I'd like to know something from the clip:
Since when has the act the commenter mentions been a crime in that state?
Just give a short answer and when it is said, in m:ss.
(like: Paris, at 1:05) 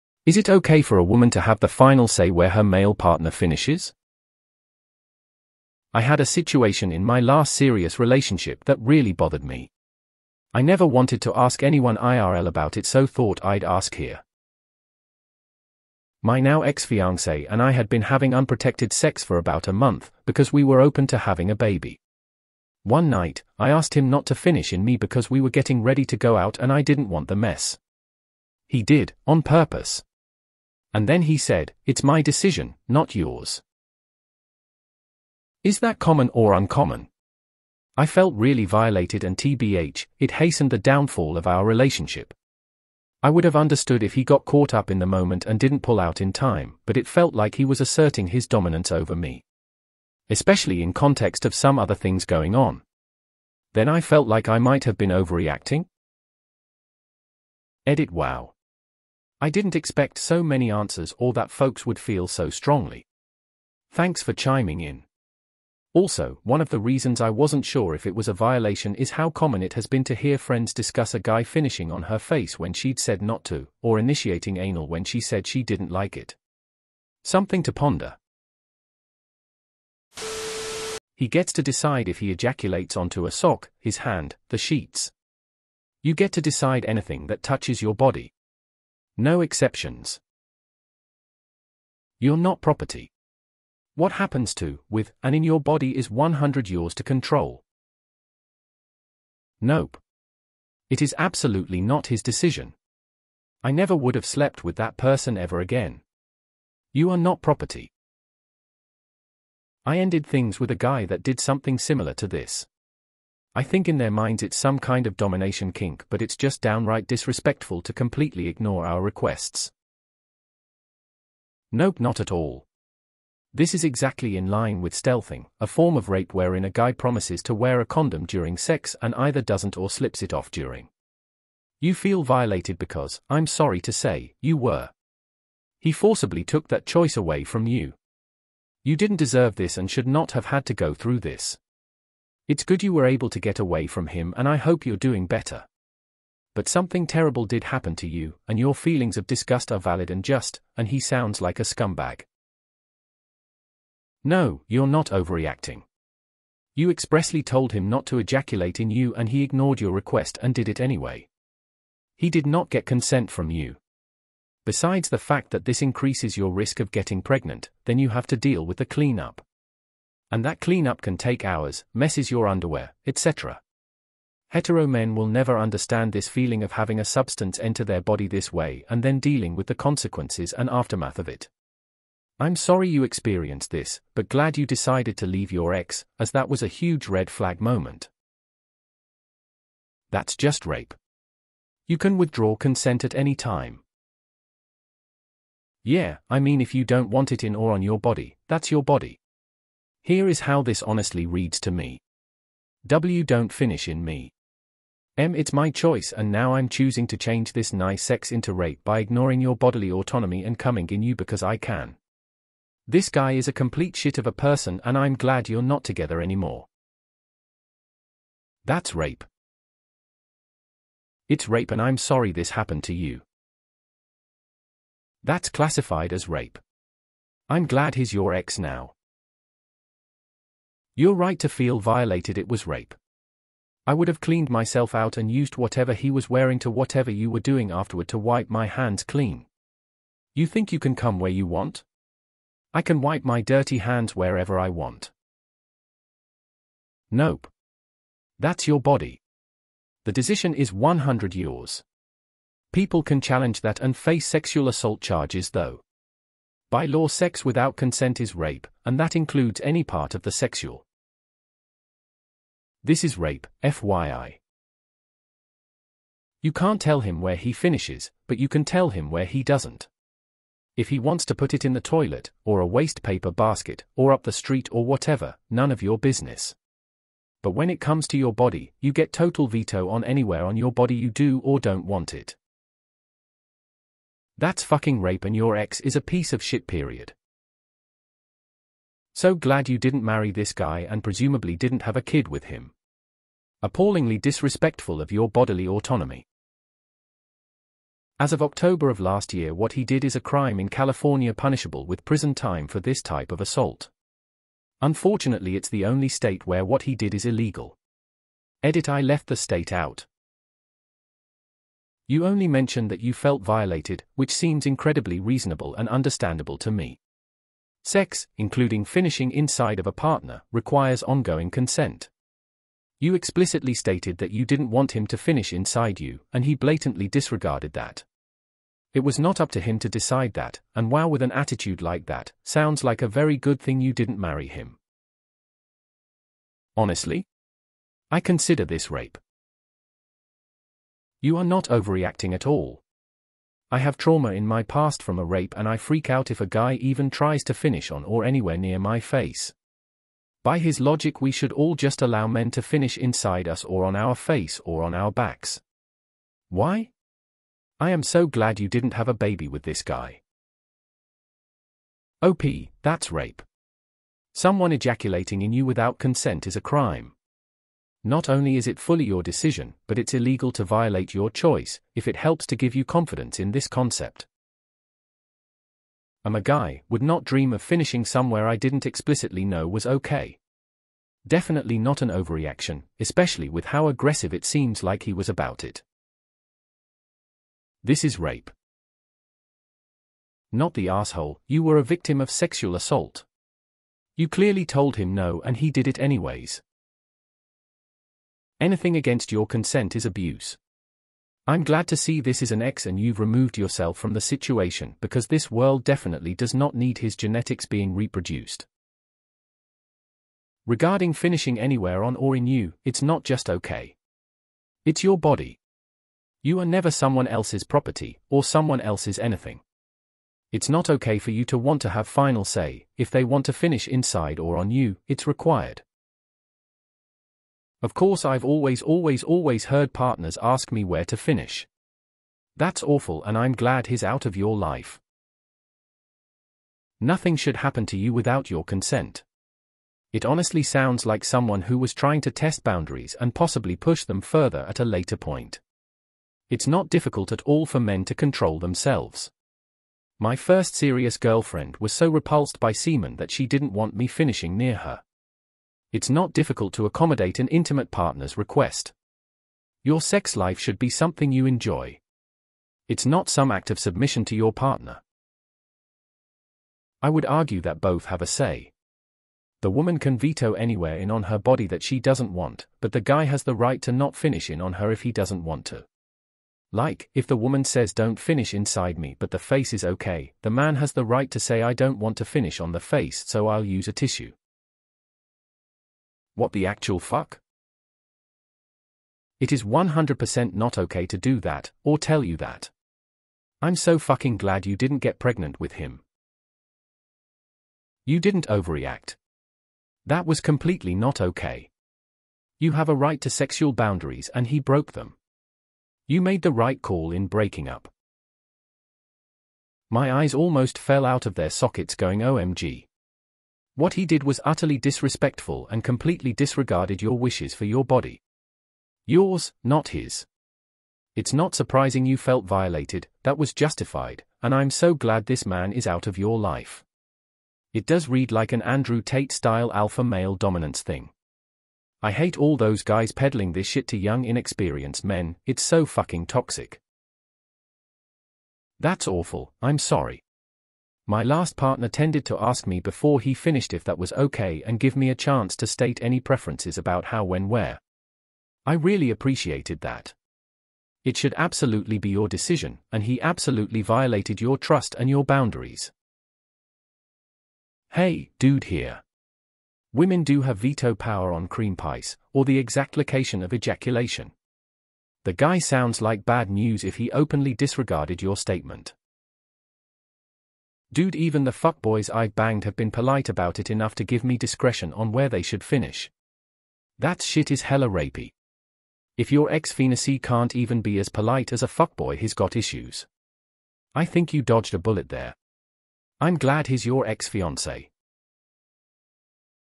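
October of last year, at 4:58.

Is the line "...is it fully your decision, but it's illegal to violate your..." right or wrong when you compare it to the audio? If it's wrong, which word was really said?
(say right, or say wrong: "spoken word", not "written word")
right.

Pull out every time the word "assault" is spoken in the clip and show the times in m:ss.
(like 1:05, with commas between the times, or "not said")
4:14, 5:03, 6:32.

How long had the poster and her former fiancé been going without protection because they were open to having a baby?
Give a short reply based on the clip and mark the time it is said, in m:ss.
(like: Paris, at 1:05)
about a month, at 0:19.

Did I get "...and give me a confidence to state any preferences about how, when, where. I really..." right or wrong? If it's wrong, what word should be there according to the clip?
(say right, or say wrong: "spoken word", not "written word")
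wrong: "chance", not "confidence".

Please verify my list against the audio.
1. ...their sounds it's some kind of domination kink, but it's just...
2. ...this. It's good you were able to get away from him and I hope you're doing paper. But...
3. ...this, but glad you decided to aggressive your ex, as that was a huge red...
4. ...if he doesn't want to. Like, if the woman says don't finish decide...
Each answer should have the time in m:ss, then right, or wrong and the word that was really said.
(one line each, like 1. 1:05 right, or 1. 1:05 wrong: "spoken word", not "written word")
1. 1:53 wrong: "minds", not "sounds"
2. 2:21 wrong: "better", not "paper"
3. 3:03 wrong: "leave", not "aggressive"
4. 7:54 wrong: "inside", not "decide".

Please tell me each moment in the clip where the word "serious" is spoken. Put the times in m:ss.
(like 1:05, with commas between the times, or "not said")
0:07, 7:30.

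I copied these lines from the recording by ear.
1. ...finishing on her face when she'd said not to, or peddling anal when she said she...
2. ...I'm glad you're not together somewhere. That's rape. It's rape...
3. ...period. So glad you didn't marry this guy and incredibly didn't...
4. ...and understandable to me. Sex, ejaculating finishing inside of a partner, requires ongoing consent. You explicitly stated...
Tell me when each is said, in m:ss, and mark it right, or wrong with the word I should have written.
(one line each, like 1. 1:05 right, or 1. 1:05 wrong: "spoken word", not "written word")
1. 1:11 wrong: "initiating", not "peddling"
2. 3:34 wrong: "anymore", not "somewhere"
3. 4:46 wrong: "presumably", not "incredibly"
4. 5:15 wrong: "including", not "ejaculating".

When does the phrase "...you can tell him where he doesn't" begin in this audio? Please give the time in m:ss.
4:28.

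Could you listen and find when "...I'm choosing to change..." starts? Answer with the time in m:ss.
3:26.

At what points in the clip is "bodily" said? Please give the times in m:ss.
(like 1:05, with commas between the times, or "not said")
3:29, 4:55.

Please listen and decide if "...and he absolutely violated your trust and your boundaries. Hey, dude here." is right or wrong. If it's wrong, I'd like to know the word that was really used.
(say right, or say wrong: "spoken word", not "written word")
right.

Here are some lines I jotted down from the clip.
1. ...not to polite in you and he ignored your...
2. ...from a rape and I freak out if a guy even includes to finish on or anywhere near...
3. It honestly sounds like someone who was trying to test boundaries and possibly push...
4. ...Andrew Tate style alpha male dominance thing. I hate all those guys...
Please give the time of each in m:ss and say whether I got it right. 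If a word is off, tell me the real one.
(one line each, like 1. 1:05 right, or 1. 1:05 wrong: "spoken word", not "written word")
1. 2:37 wrong: "ejaculate", not "polite"
2. 5:45 wrong: "tries", not "includes"
3. 7:20 right
4. 8:48 right.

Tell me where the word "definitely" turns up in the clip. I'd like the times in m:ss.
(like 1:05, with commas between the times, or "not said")
6:21, 6:45.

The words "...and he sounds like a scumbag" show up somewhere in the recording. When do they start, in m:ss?
2:30.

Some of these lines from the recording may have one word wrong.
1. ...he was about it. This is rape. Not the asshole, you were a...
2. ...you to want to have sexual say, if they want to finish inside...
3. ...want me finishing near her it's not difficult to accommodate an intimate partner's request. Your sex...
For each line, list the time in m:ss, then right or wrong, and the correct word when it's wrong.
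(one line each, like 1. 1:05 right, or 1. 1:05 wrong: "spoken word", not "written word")
1. 6:25 right
2. 7:01 wrong: "final", not "sexual"
3. 7:33 right.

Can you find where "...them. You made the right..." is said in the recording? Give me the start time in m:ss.
8:24.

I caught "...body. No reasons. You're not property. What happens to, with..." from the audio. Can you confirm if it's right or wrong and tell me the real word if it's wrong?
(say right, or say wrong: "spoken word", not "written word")
wrong: "exceptions", not "reasons".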